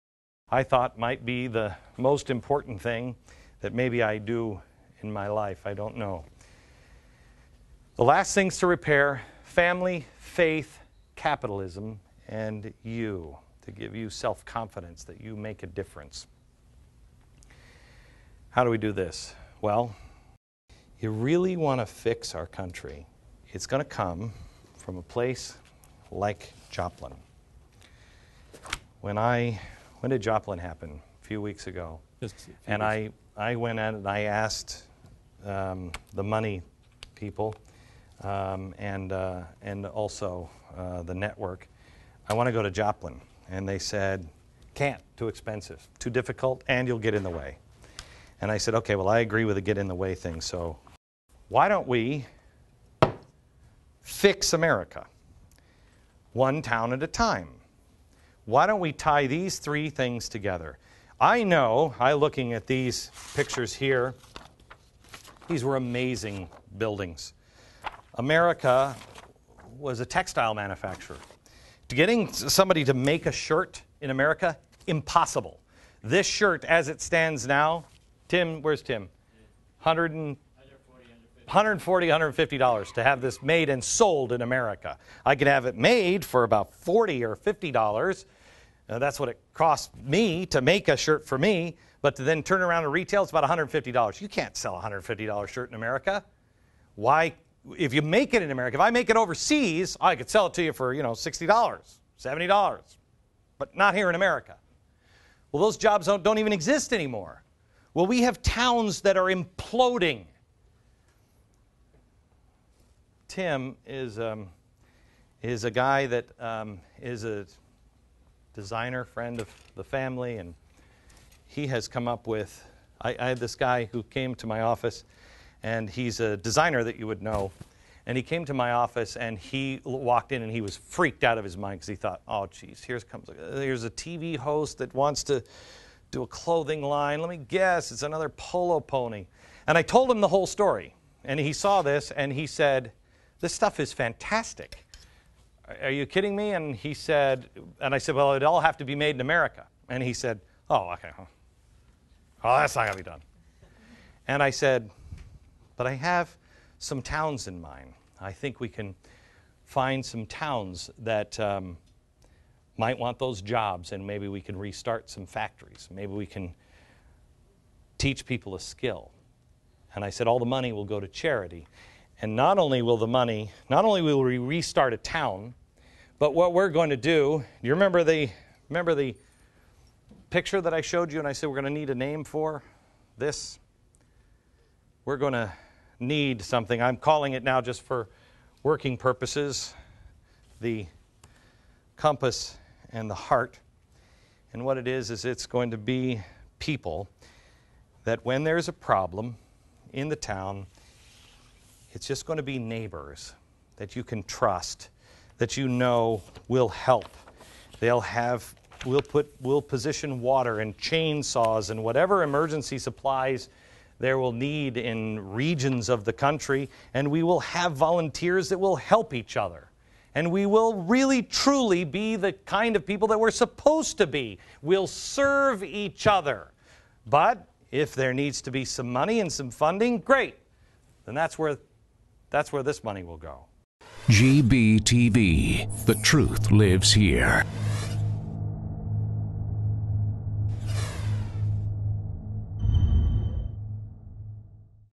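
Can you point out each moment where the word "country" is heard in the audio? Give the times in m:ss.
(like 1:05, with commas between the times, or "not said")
0:22, 3:36.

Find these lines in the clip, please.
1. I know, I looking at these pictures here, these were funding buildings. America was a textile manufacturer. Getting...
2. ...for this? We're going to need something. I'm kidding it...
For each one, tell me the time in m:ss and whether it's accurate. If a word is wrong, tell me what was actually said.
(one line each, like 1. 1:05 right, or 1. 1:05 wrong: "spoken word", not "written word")
1. 1:01 wrong: "amazing", not "funding"
2. 3:02 wrong: "calling", not "kidding".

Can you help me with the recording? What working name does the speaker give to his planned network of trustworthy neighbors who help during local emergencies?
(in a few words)
The compass and the heart.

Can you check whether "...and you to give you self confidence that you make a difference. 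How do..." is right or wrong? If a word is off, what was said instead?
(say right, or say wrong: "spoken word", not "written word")
right.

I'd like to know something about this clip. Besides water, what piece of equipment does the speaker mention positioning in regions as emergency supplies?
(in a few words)
Chainsaws.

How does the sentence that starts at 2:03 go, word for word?
I, I had this guy who came to my office, and he's a designer that you would know.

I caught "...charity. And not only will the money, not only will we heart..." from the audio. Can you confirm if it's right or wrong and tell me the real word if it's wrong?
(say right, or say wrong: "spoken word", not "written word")
wrong: "restart", not "heart".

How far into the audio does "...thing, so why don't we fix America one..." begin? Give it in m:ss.
0:50.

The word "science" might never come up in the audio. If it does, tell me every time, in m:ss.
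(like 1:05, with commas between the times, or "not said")
not said.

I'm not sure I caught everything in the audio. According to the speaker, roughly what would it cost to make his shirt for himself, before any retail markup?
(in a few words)
$40 or $50.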